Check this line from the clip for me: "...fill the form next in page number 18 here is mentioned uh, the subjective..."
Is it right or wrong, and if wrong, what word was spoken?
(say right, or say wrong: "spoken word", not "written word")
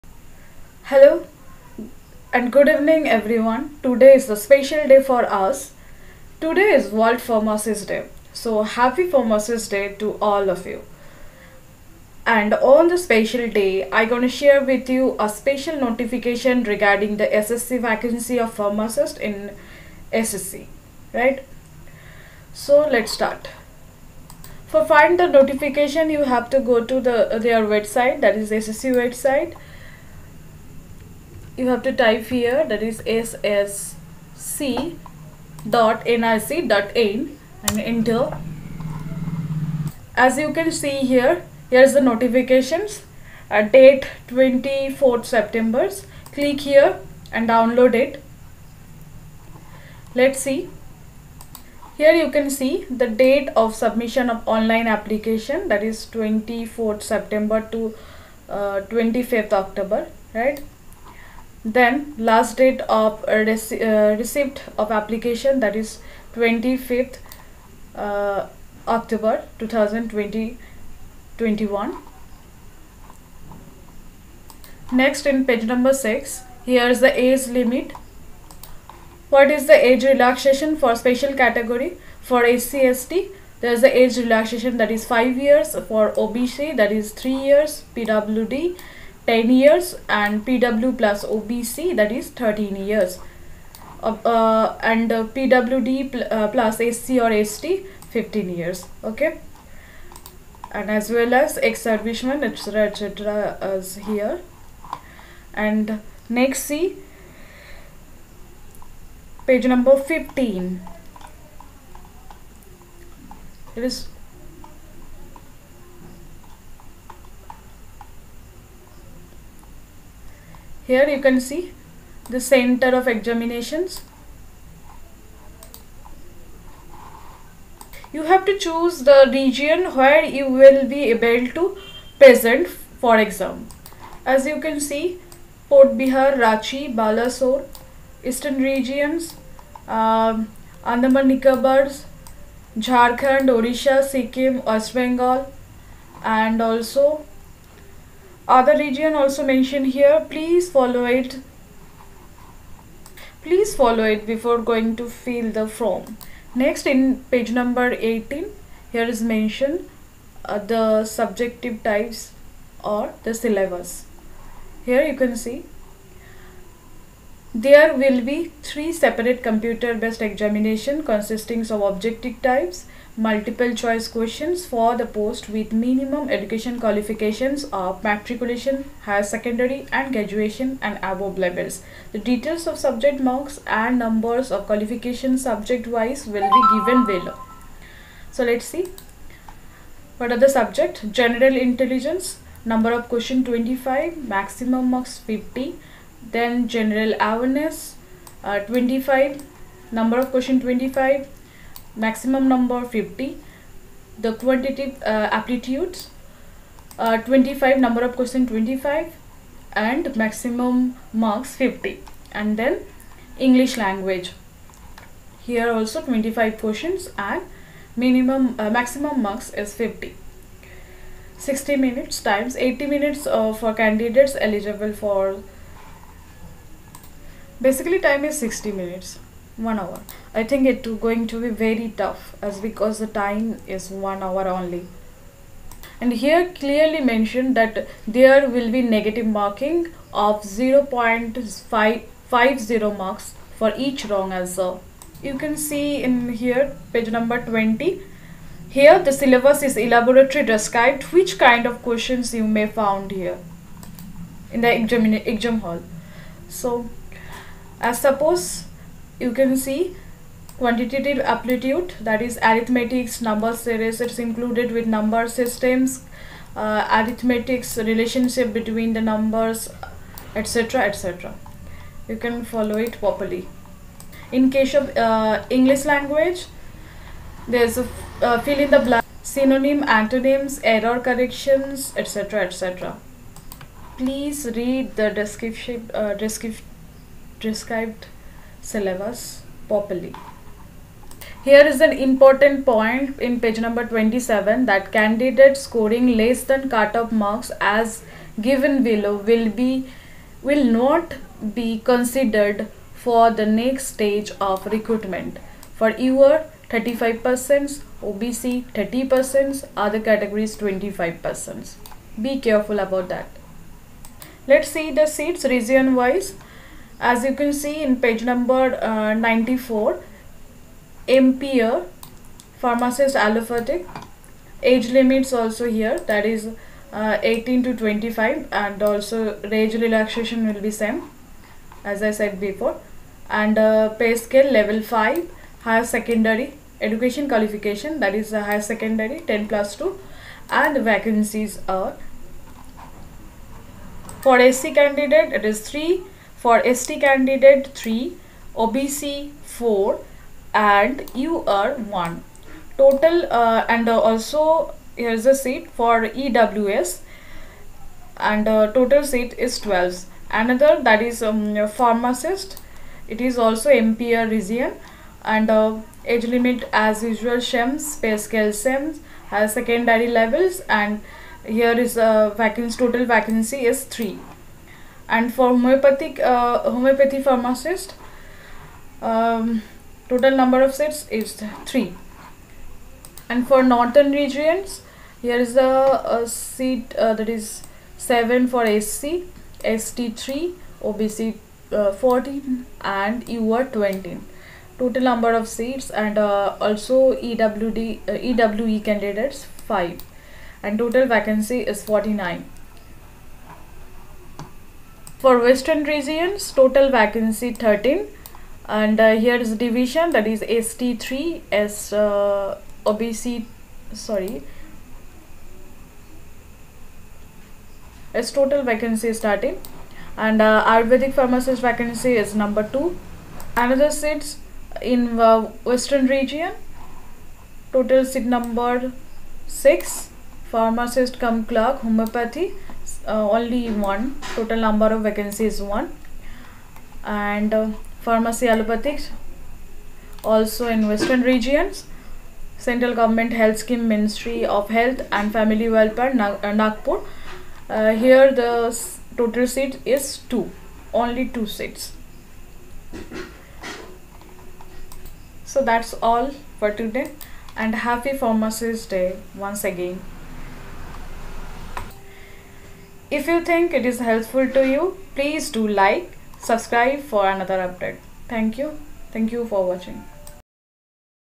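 right.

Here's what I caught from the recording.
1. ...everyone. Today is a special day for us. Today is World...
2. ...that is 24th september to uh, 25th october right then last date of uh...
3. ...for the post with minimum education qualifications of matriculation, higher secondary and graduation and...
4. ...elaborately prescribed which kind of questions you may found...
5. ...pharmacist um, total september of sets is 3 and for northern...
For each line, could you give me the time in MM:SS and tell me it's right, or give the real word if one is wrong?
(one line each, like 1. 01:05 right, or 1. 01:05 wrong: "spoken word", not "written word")
1. 00:03 right
2. 00:55 right
3. 02:54 right
4. 04:09 wrong: "described", not "prescribed"
5. 06:17 wrong: "number", not "september".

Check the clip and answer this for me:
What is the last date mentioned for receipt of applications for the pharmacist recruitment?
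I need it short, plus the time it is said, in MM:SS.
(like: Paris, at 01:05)
25 October 2021, at 01:06.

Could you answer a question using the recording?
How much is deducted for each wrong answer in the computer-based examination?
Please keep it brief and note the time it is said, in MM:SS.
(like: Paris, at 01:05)
0.50 marks, at 04:00.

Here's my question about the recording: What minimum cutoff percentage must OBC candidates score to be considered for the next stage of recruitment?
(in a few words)
30%.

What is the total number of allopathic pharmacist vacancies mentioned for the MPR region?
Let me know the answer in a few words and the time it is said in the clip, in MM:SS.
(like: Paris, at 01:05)
12, at 05:58.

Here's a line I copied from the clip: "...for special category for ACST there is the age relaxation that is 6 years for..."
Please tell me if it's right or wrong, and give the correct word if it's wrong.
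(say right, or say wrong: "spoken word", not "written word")
wrong: "5", not "6".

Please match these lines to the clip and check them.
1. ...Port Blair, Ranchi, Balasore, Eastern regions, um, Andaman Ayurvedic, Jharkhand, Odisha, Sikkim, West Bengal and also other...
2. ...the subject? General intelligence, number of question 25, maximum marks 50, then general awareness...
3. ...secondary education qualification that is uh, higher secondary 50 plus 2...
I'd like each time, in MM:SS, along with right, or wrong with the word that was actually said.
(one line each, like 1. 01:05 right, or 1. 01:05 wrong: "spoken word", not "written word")
1. 02:15 wrong: "Nicobars", not "Ayurvedic"
2. 03:10 right
3. 05:35 wrong: "10", not "50".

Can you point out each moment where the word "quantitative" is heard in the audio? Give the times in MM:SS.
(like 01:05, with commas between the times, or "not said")
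03:24, 04:20.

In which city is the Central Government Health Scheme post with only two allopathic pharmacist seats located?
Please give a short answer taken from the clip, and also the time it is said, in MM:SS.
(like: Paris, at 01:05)
Nagpur, at 07:26.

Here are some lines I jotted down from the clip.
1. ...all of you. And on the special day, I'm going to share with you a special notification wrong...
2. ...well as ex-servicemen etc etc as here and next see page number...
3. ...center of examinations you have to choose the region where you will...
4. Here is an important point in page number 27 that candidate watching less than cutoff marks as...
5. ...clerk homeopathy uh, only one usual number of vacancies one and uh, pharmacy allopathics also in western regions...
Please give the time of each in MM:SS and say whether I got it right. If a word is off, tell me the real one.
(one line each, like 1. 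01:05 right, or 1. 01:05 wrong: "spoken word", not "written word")
1. 00:10 wrong: "regarding", not "wrong"
2. 01:41 right
3. 02:02 right
4. 04:51 wrong: "scoring", not "watching"
5. 07:11 wrong: "total", not "usual".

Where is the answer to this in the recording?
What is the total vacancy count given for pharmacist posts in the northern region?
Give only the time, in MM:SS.
06:40.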